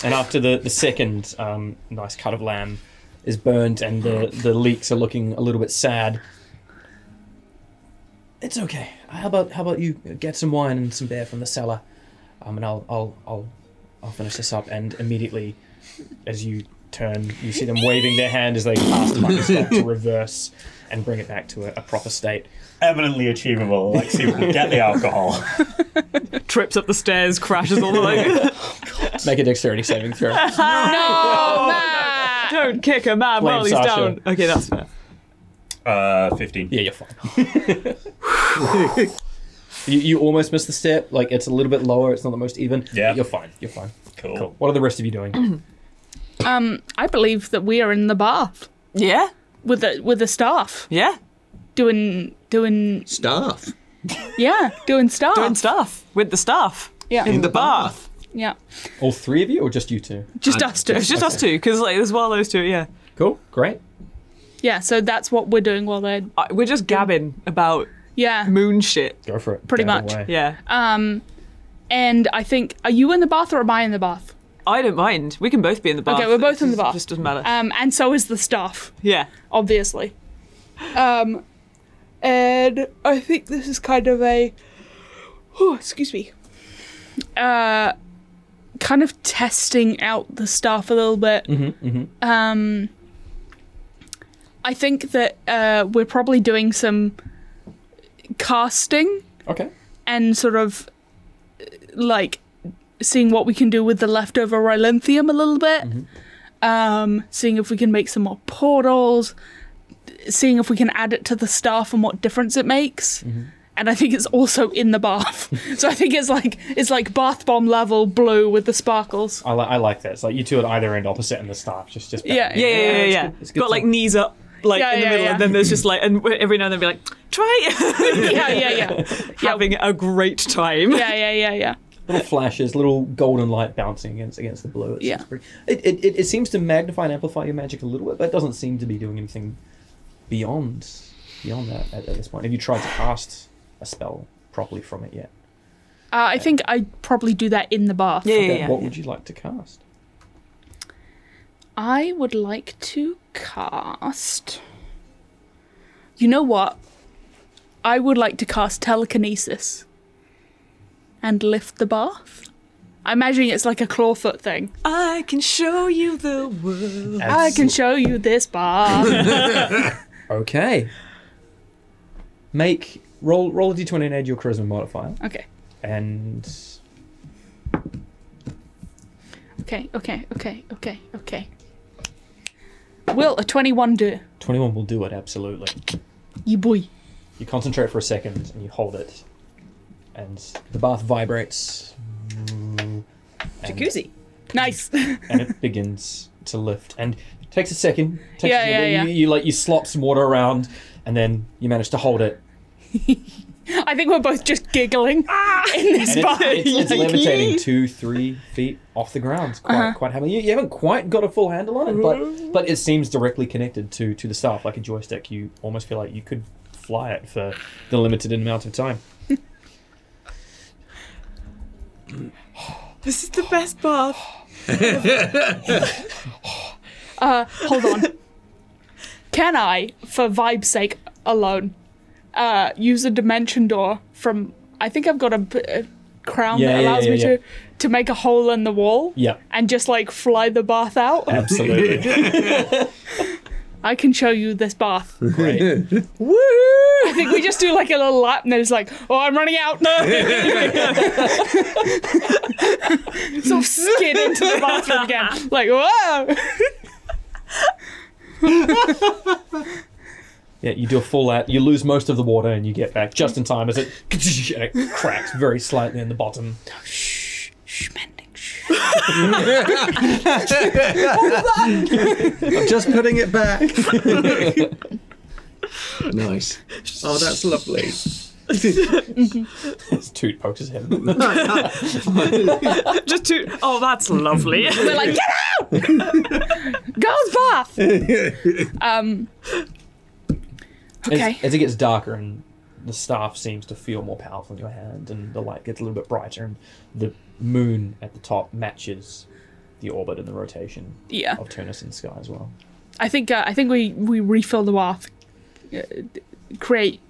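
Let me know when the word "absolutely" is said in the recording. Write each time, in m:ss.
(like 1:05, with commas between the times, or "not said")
3:05, 4:01.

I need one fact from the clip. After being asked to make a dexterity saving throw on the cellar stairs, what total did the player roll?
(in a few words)
15.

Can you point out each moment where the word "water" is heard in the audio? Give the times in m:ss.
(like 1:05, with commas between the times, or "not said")
3:20, 4:22.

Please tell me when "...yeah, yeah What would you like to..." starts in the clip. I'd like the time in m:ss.
2:28.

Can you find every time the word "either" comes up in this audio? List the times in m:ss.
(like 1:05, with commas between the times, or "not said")
2:00.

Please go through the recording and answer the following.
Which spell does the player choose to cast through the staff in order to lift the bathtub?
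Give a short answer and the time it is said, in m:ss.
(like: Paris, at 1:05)
telekinesis, at 2:38.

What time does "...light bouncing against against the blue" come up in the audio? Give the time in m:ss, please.
2:13.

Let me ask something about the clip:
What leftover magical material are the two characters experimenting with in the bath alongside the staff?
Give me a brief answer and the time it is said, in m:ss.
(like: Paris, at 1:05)
Rylanthium, at 1:44.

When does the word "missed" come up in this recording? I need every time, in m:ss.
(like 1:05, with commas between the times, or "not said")
0:40.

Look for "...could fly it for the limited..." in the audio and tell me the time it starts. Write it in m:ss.
3:36.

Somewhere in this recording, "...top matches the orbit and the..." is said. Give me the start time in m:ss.
4:58.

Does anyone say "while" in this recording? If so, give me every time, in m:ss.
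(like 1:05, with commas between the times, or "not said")
0:33, 1:05.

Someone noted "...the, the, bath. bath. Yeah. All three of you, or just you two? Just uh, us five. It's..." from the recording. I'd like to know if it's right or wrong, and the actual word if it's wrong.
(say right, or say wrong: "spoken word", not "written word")
wrong: "two", not "five".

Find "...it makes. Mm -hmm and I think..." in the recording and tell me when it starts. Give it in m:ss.
1:52.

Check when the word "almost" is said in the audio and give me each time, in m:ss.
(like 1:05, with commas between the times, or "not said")
0:40, 3:35.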